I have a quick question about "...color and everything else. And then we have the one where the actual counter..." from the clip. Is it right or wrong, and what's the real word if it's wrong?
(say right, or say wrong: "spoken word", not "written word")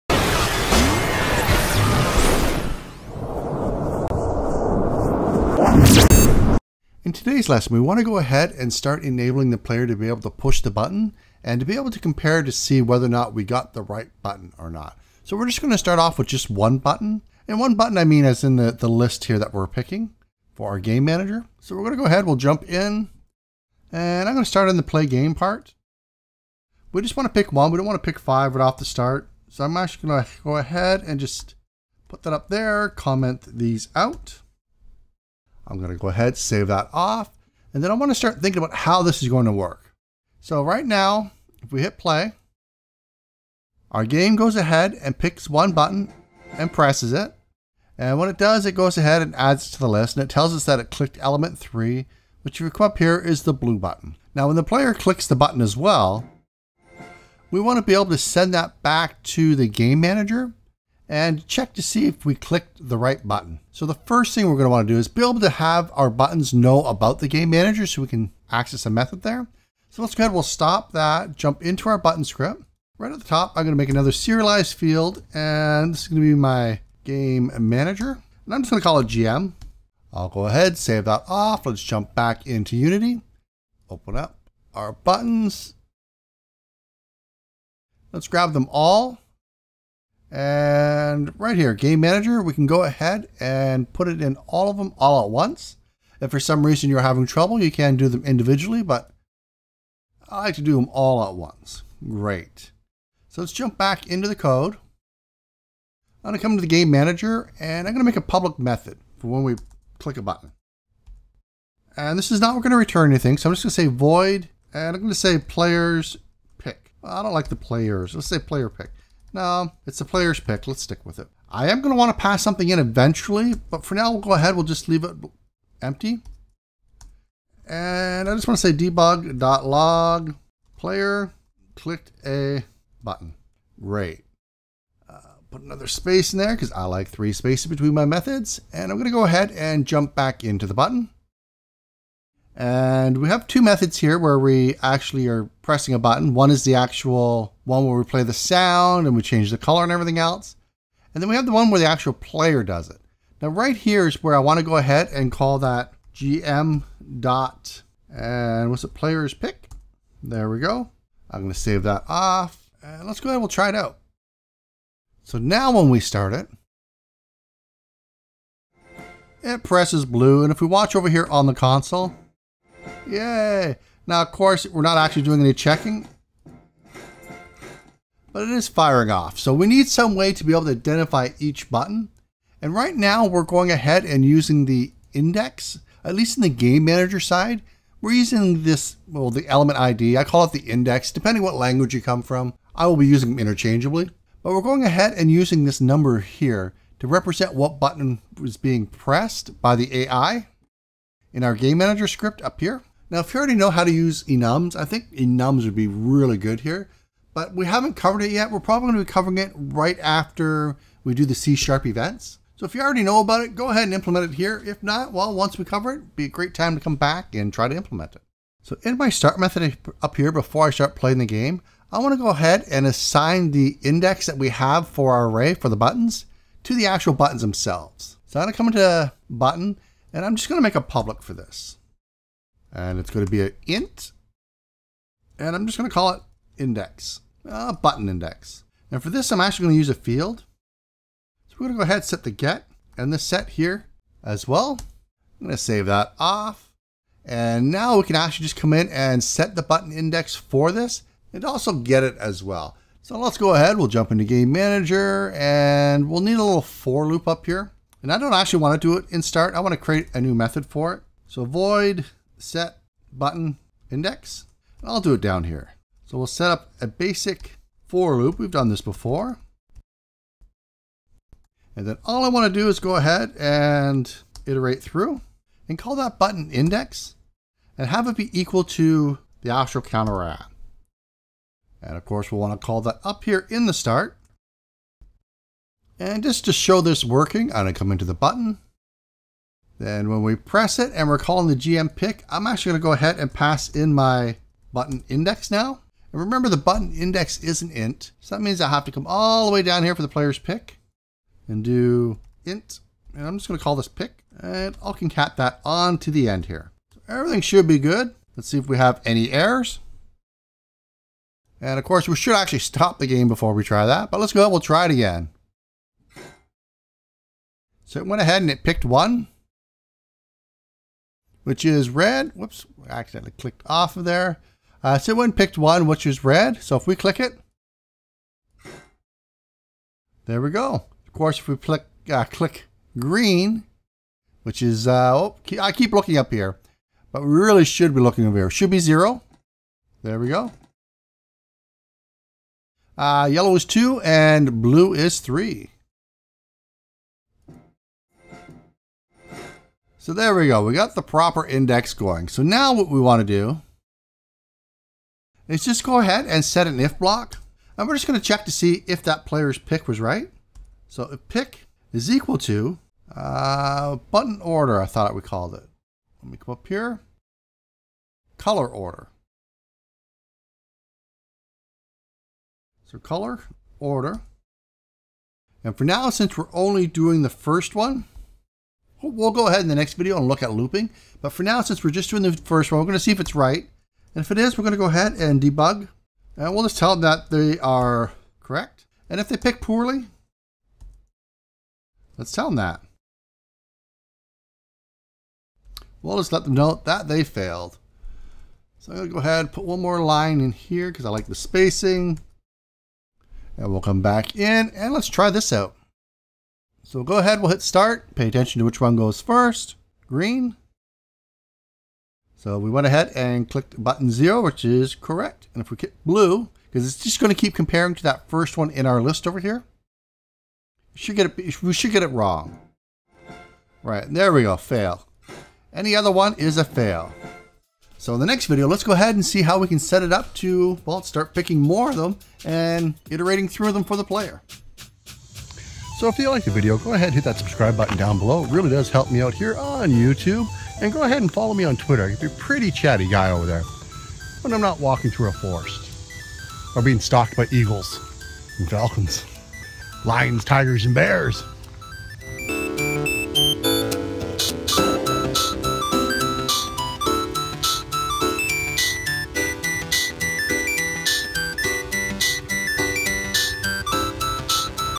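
wrong: "player", not "counter".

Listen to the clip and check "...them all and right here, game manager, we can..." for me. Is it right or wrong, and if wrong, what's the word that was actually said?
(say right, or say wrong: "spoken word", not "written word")
right.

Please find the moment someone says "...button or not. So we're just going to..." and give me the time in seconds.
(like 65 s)
14 s.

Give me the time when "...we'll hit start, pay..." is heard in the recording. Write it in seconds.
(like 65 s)
407 s.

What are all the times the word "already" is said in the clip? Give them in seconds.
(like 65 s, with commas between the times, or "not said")
203 s, 212 s.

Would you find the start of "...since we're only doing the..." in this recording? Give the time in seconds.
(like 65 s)
376 s.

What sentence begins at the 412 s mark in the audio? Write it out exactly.
So we went ahead and clicked button zero, which is correct.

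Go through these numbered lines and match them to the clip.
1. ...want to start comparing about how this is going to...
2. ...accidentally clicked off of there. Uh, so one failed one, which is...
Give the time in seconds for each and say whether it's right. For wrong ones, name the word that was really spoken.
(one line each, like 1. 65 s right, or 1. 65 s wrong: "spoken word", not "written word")
1. 37 s wrong: "thinking", not "comparing"
2. 322 s wrong: "picked", not "failed".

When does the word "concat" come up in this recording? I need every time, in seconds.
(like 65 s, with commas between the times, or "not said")
304 s.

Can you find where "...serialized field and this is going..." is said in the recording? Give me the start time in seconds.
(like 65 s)
74 s.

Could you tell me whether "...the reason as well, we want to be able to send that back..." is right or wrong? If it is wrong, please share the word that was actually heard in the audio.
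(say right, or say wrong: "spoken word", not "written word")
wrong: "button", not "reason".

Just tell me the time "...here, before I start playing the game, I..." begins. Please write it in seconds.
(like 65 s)
220 s.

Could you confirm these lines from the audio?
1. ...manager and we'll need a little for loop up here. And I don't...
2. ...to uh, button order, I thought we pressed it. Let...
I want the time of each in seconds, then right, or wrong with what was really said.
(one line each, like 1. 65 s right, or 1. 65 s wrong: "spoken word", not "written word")
1. 254 s right
2. 362 s wrong: "called", not "pressed".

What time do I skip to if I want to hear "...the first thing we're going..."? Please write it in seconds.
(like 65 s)
63 s.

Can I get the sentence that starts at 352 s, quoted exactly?
So now what we want to do is just go ahead and set an if block.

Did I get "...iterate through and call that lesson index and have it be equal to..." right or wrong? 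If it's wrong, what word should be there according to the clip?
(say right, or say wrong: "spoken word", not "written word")
wrong: "button", not "lesson".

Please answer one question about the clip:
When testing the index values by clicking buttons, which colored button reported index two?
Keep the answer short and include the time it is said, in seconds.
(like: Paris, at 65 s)
Yellow, at 343 s.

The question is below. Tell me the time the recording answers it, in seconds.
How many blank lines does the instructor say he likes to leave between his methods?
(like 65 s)
137 s.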